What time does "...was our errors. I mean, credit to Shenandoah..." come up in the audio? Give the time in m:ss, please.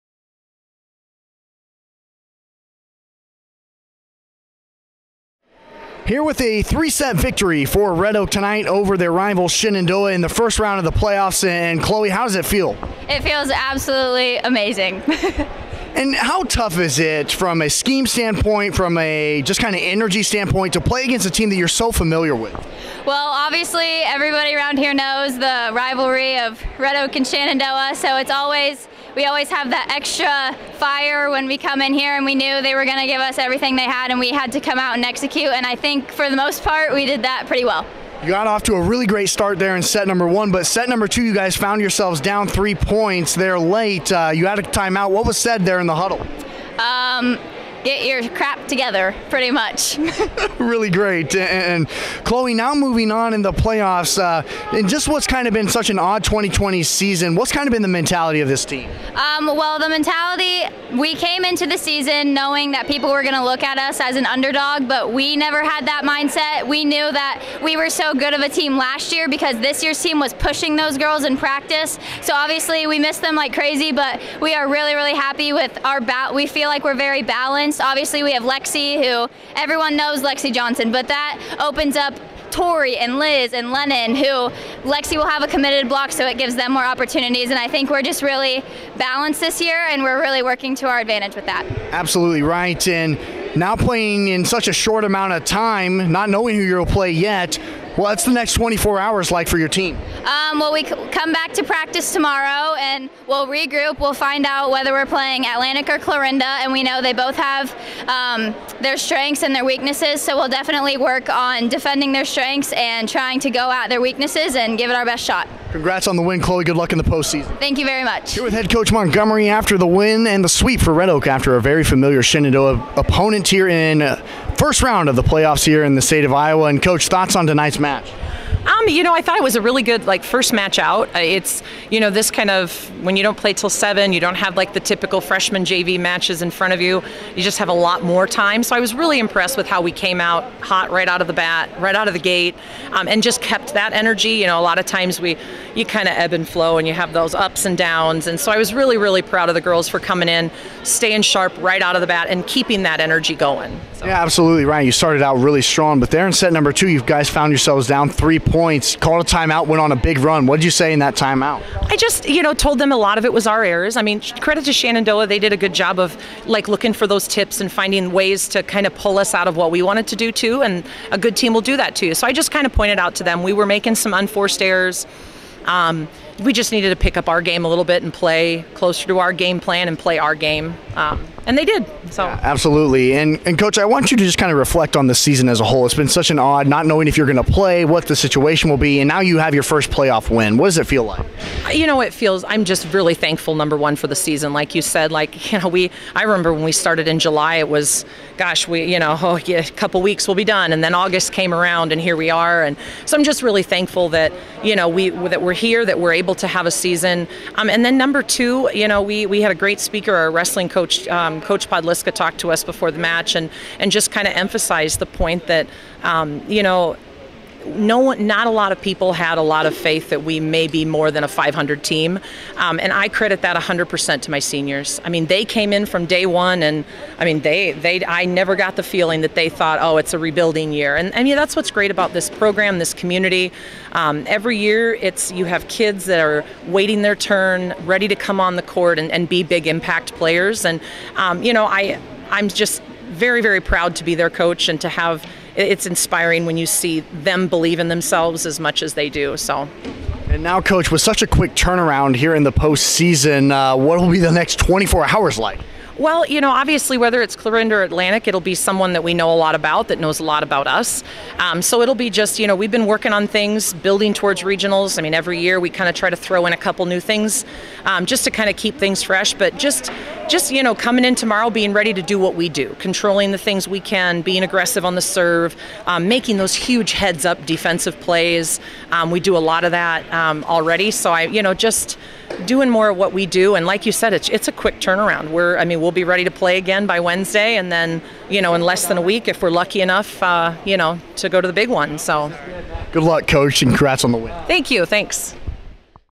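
2:43.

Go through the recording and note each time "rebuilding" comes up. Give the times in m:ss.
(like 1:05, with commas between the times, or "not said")
3:50.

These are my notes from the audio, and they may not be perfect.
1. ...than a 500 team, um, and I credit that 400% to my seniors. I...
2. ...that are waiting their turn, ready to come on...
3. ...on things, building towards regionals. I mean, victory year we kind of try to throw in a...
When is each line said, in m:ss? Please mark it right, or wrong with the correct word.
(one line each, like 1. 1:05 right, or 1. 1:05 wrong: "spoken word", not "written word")
1. 3:41 wrong: "100", not "400"
2. 3:56 right
3. 4:23 wrong: "every", not "victory".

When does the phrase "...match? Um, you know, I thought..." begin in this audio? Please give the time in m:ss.
2:07.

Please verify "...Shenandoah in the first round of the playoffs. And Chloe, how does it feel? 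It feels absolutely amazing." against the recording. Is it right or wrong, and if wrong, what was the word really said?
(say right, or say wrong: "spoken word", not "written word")
right.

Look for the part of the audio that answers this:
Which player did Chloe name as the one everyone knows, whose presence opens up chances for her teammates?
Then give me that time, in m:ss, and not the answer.
1:20.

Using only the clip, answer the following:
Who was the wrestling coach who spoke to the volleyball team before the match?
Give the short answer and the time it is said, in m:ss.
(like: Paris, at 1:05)
Coach Podliska, at 3:31.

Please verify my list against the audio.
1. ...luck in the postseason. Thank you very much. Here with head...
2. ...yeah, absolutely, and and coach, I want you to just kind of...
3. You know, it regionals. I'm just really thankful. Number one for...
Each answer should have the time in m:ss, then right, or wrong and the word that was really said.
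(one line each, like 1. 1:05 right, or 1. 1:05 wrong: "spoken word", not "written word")
1. 1:56 right
2. 3:02 right
3. 3:11 wrong: "feels", not "regionals".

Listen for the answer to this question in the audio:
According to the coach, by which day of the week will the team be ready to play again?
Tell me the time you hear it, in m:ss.
4:47.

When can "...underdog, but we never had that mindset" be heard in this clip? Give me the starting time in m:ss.
1:04.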